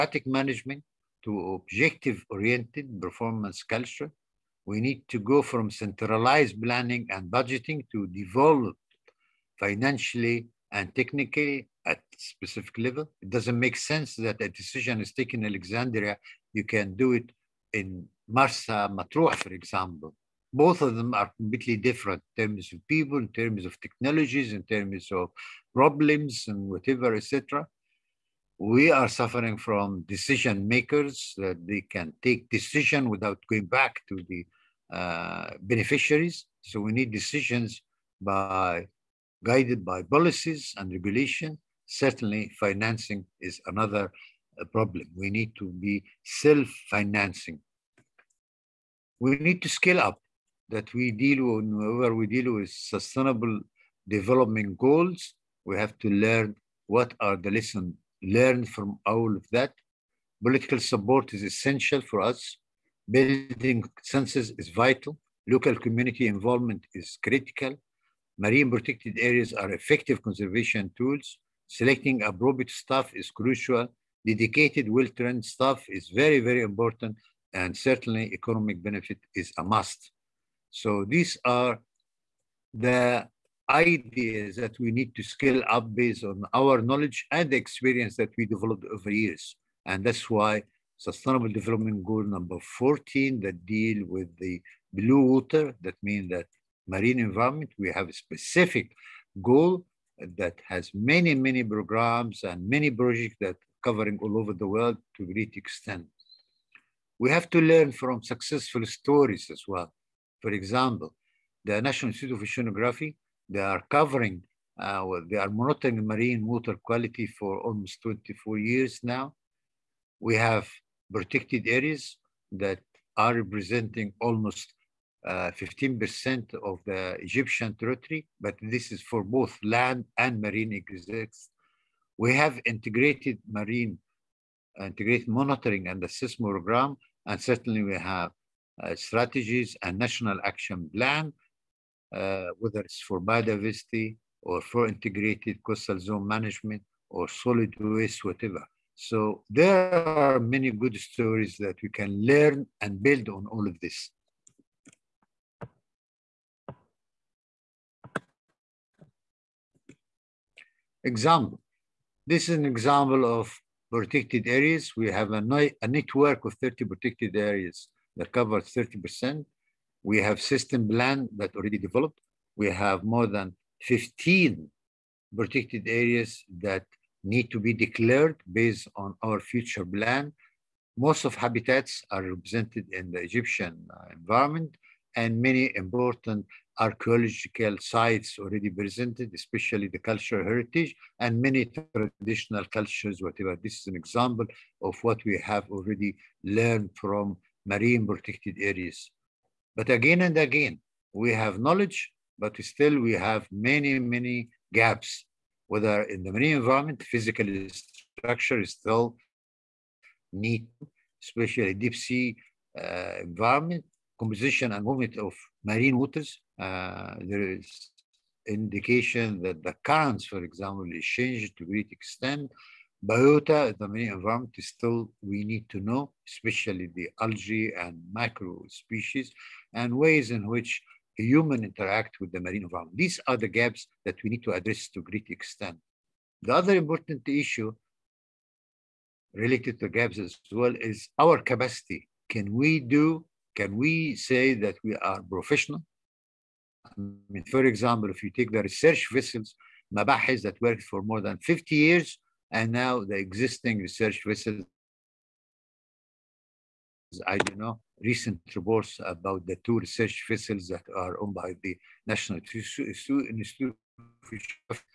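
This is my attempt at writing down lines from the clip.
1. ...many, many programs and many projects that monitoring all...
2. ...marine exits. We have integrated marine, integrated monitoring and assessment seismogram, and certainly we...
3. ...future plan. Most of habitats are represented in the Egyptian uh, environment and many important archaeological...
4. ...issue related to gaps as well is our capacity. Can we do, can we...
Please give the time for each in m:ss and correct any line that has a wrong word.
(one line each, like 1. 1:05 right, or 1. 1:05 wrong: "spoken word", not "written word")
1. 1:40 wrong: "covering", not "monitoring"
2. 2:10 right
3. 2:59 right
4. 3:57 right.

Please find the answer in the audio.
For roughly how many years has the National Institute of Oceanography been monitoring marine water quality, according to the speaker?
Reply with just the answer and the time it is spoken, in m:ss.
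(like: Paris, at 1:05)
24 years, at 1:58.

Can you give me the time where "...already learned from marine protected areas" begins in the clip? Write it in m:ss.
3:15.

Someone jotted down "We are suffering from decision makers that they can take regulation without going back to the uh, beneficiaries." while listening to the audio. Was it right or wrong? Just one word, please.
wrong.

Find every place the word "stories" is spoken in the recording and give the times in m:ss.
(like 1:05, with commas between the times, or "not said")
1:48, 2:30.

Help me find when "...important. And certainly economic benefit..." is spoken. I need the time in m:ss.
1:16.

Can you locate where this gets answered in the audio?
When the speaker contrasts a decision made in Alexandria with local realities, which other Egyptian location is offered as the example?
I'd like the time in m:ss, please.
0:18.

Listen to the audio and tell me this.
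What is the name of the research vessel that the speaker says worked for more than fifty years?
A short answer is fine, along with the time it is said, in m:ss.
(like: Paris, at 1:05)
Mabahis, at 4:09.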